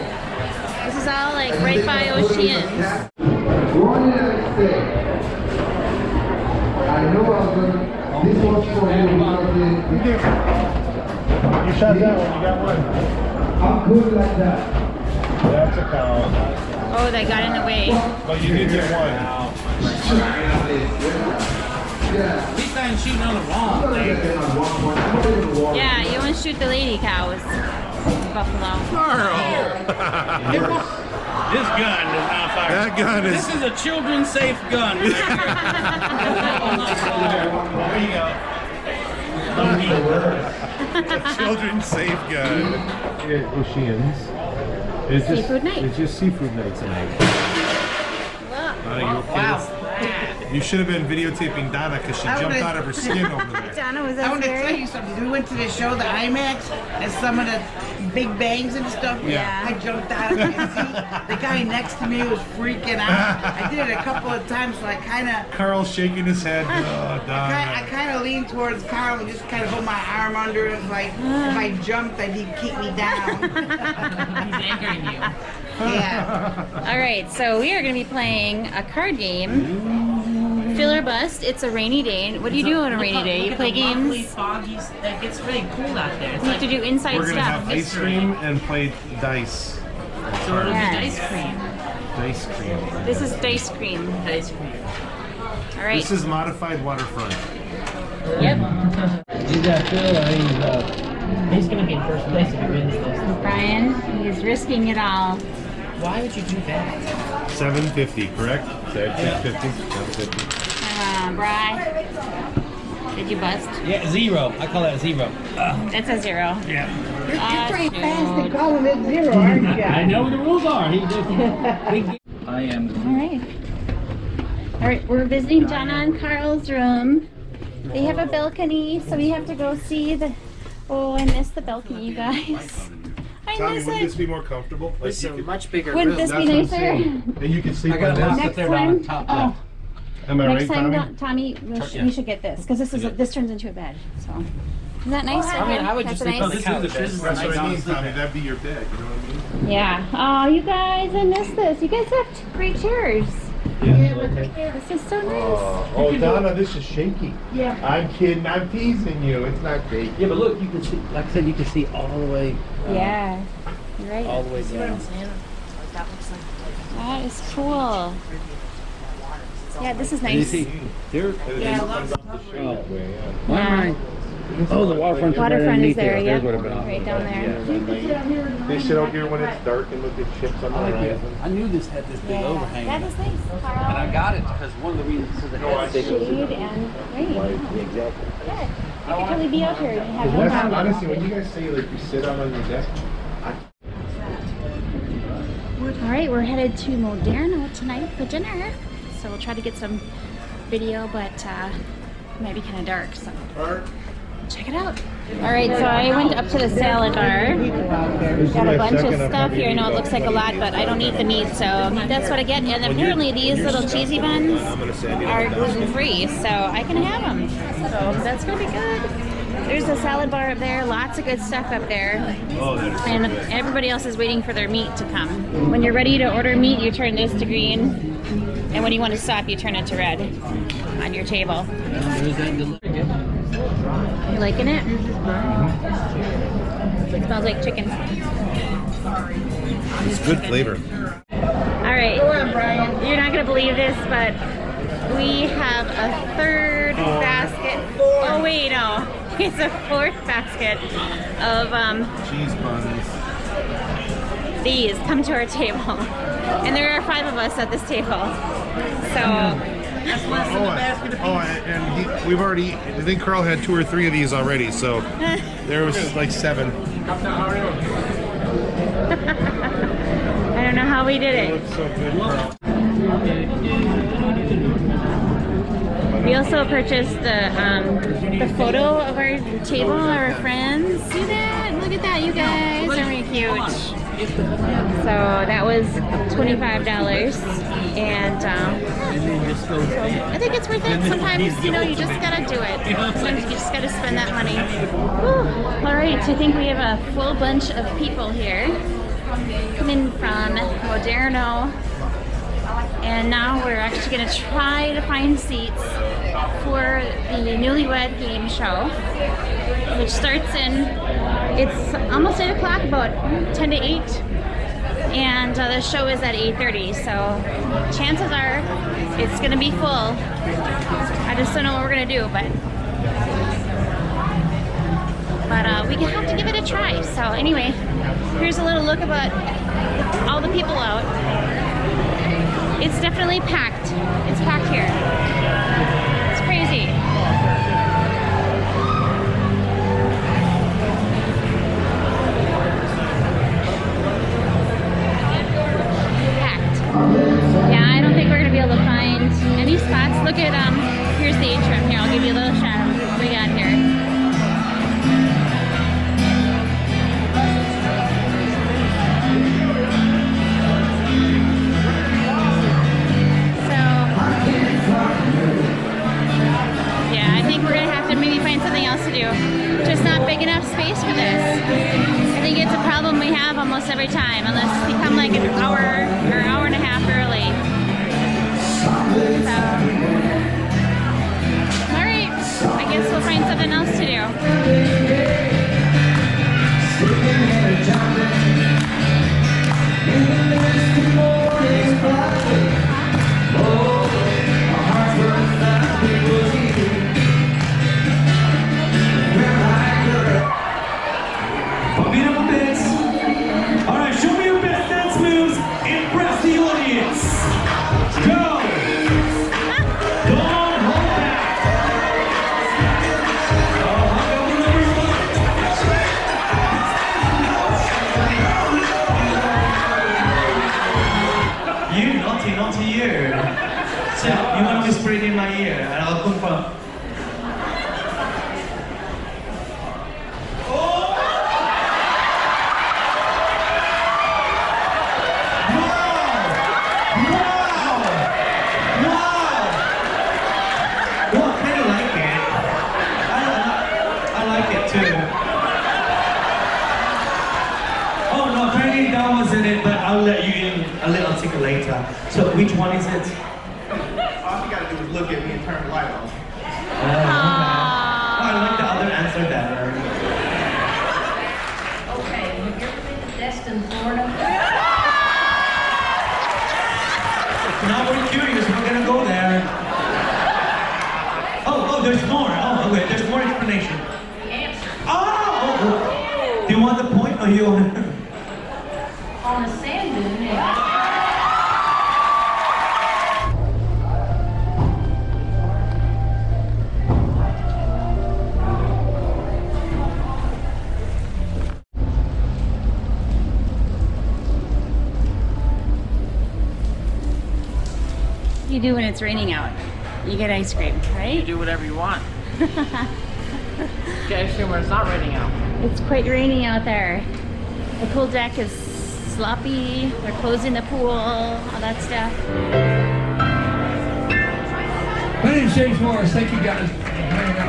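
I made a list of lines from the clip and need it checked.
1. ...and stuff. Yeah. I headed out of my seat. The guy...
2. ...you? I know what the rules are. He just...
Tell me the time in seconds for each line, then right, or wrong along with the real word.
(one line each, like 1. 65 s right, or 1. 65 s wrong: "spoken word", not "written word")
1. 58 s wrong: "jumped", not "headed"
2. 119 s right.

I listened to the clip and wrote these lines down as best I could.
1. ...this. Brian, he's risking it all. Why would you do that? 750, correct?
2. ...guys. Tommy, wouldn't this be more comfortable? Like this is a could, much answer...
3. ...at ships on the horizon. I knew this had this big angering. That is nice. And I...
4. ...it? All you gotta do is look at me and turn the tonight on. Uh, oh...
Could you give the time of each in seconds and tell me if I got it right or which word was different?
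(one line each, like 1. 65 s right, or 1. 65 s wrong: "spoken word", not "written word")
1. 102 s right
2. 132 s wrong: "bigger", not "answer"
3. 180 s wrong: "overhang", not "angering"
4. 453 s wrong: "light", not "tonight".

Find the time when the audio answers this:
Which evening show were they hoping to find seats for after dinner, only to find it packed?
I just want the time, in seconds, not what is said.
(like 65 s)
307 s.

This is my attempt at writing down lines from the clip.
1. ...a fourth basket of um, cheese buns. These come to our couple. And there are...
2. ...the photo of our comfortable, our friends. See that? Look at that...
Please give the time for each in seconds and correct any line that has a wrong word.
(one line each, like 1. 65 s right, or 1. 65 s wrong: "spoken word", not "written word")
1. 249 s wrong: "table", not "couple"
2. 278 s wrong: "table", not "comfortable".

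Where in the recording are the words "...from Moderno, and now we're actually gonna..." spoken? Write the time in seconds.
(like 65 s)
300 s.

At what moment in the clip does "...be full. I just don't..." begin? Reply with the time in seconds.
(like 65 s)
319 s.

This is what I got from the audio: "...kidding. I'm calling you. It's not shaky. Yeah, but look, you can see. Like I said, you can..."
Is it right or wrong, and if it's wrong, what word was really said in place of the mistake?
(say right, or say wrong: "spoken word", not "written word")
wrong: "teasing", not "calling".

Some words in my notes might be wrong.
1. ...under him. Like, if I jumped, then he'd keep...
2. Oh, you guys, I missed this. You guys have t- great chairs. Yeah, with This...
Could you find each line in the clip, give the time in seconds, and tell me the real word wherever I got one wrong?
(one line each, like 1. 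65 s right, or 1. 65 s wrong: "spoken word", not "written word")
1. 70 s right
2. 150 s right.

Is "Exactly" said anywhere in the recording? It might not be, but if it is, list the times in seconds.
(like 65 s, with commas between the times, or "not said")
187 s.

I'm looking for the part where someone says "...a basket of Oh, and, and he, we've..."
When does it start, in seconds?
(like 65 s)
260 s.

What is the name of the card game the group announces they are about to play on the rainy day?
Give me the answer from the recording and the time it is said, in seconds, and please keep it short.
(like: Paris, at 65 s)
Fill or Bust, at 80 s.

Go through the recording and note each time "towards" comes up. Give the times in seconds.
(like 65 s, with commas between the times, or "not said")
68 s.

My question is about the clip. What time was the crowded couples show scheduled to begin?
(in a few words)
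8:30.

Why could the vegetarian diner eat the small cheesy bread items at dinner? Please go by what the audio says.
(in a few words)
Gluten-free.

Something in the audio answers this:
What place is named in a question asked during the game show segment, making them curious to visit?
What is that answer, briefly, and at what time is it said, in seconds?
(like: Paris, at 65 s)
Destin, Florida, at 463 s.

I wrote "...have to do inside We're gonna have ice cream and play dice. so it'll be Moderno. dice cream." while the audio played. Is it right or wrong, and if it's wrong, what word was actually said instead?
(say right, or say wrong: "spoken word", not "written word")
wrong: "Yes", not "Moderno".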